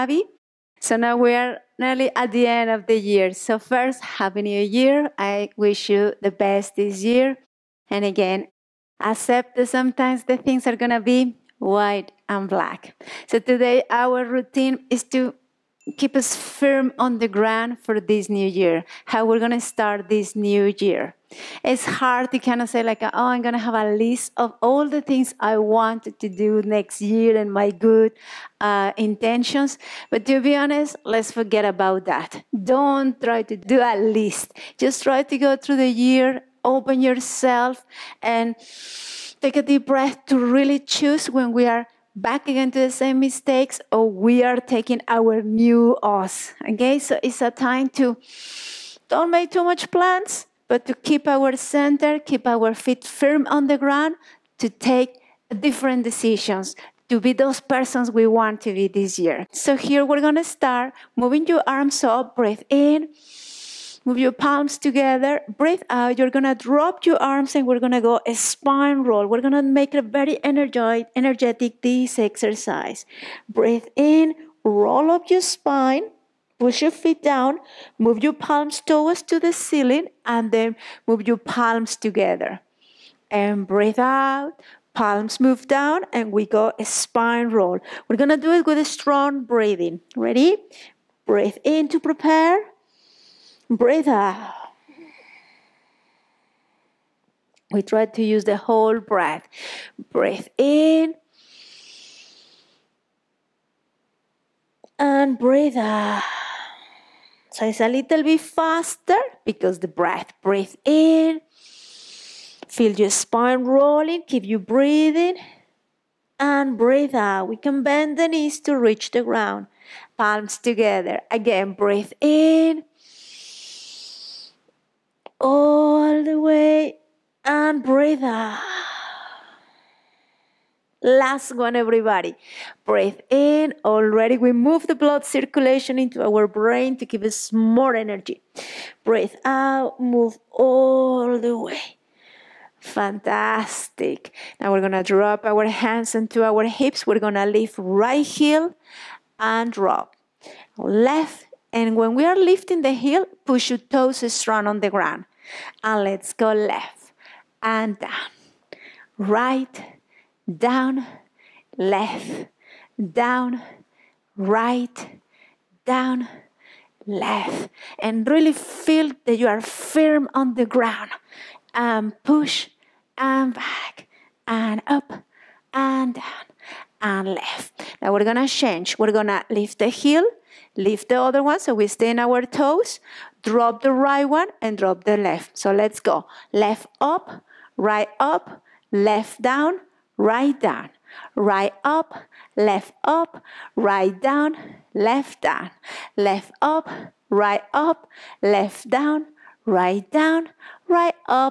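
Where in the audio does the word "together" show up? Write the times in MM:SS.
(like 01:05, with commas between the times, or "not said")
01:04, 01:21, 02:00.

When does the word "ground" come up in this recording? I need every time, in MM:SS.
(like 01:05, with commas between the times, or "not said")
00:17, 00:53, 01:59, 02:34, 02:50.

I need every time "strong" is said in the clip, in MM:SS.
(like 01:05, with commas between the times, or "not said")
01:28, 02:34.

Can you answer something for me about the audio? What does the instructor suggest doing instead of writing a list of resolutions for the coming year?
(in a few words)
Take a deep breath.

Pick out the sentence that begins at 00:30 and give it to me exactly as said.
But to be honest, let's forget about that.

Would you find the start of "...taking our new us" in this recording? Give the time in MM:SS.
00:44.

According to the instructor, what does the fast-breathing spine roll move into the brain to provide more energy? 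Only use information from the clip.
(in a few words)
Blood circulation.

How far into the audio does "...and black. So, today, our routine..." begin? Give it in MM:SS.
00:12.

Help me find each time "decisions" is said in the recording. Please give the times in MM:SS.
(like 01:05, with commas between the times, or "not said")
00:56.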